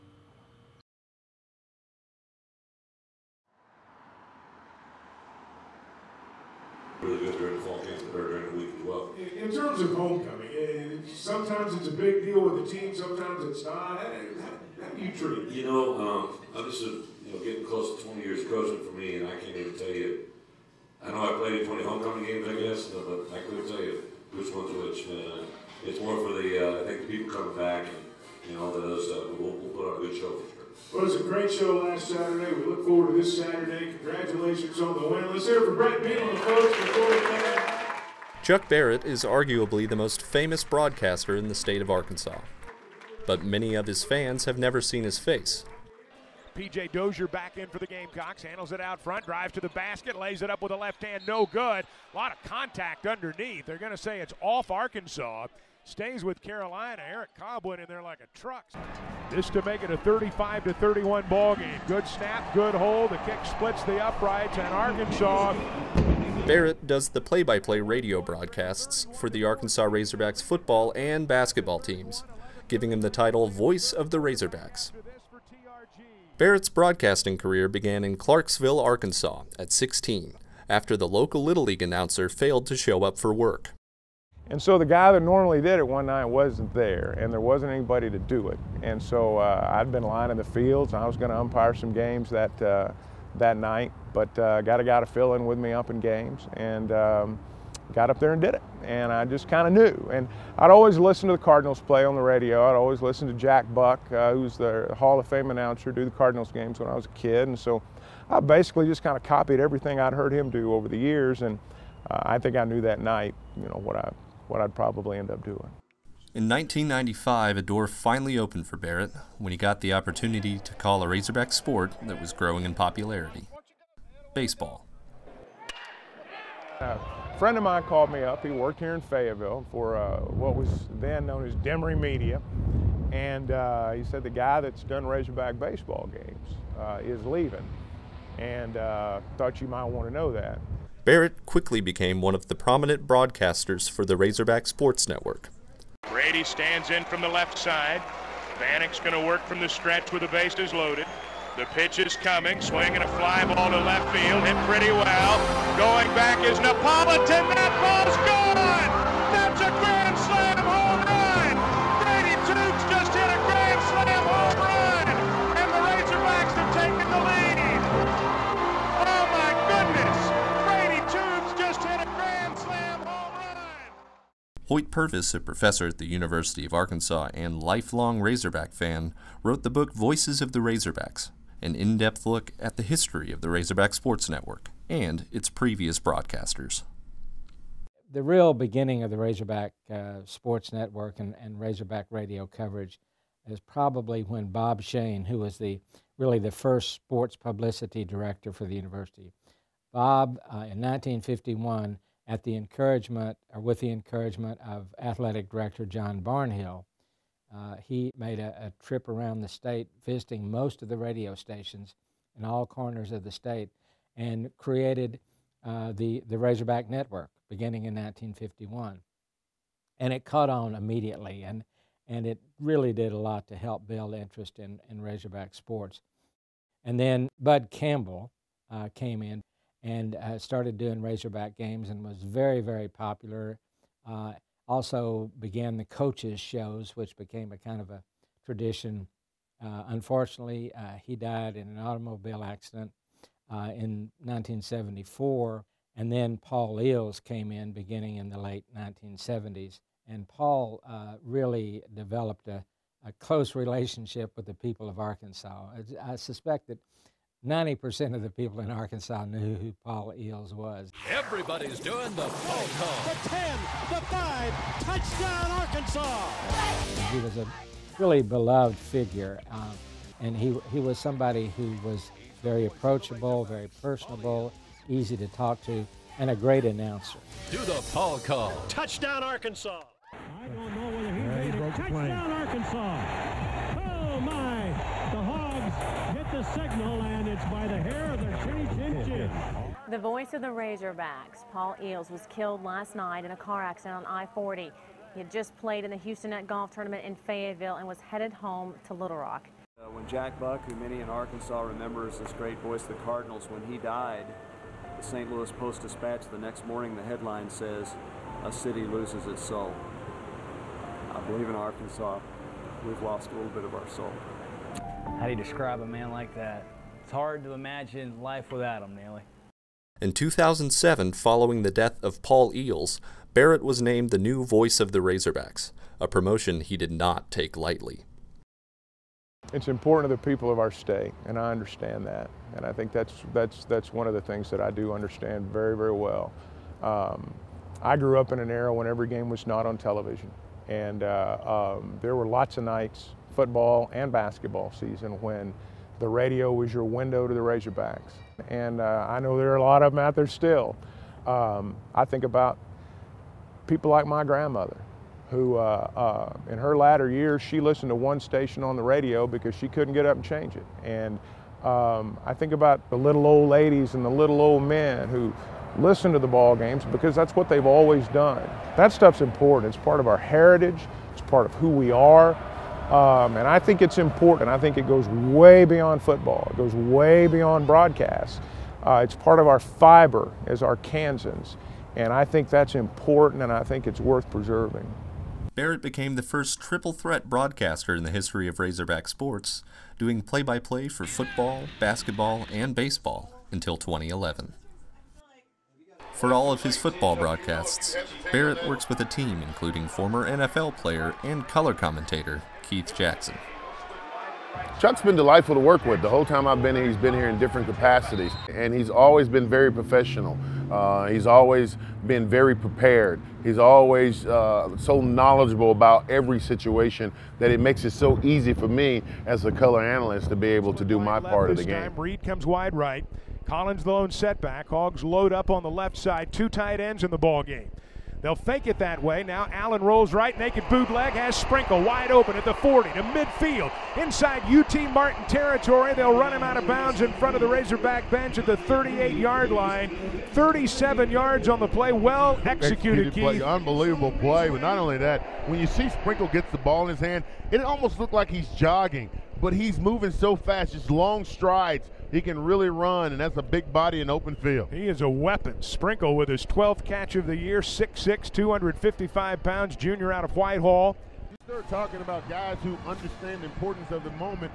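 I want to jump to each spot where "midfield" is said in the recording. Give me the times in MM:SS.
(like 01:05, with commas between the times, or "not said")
07:13.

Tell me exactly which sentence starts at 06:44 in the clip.
Chuck's been delightful to work with.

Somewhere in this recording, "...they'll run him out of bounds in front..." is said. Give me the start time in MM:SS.
07:15.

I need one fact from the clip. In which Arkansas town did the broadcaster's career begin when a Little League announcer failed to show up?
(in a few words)
Clarksville.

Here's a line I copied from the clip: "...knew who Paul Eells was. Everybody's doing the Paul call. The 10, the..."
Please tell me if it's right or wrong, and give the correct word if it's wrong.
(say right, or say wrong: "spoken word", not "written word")
right.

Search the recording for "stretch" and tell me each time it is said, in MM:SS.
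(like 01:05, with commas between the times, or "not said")
02:29.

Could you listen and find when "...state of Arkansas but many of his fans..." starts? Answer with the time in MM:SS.
00:41.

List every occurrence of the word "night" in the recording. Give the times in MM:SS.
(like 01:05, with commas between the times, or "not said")
01:26, 01:33, 01:52, 04:52, 05:42.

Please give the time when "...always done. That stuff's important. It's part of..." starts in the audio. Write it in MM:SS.
06:07.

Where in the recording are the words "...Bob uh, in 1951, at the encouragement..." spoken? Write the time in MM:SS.
03:19.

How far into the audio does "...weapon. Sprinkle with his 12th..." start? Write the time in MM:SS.
07:35.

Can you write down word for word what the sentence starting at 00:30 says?
Well, it was a great show last Saturday.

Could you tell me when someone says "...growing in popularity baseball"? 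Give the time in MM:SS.
02:02.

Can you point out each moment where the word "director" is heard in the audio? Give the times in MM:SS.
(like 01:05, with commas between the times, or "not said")
03:18, 03:25.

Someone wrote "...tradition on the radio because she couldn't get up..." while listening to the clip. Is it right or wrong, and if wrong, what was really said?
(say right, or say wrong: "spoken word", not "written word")
wrong: "station", not "tradition".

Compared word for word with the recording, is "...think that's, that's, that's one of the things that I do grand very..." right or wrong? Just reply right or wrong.
wrong.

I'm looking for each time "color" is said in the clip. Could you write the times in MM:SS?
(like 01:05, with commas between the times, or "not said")
06:41, 06:59.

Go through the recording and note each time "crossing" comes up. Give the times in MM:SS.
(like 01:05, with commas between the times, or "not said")
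not said.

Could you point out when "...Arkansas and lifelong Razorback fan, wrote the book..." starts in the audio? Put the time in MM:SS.
02:56.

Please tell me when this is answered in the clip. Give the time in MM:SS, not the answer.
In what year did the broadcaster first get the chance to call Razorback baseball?
01:56.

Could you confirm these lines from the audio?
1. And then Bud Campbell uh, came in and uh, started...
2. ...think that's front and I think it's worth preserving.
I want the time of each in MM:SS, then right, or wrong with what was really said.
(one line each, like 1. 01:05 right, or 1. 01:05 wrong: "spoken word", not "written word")
1. 03:46 right
2. 06:22 wrong: "important", not "front".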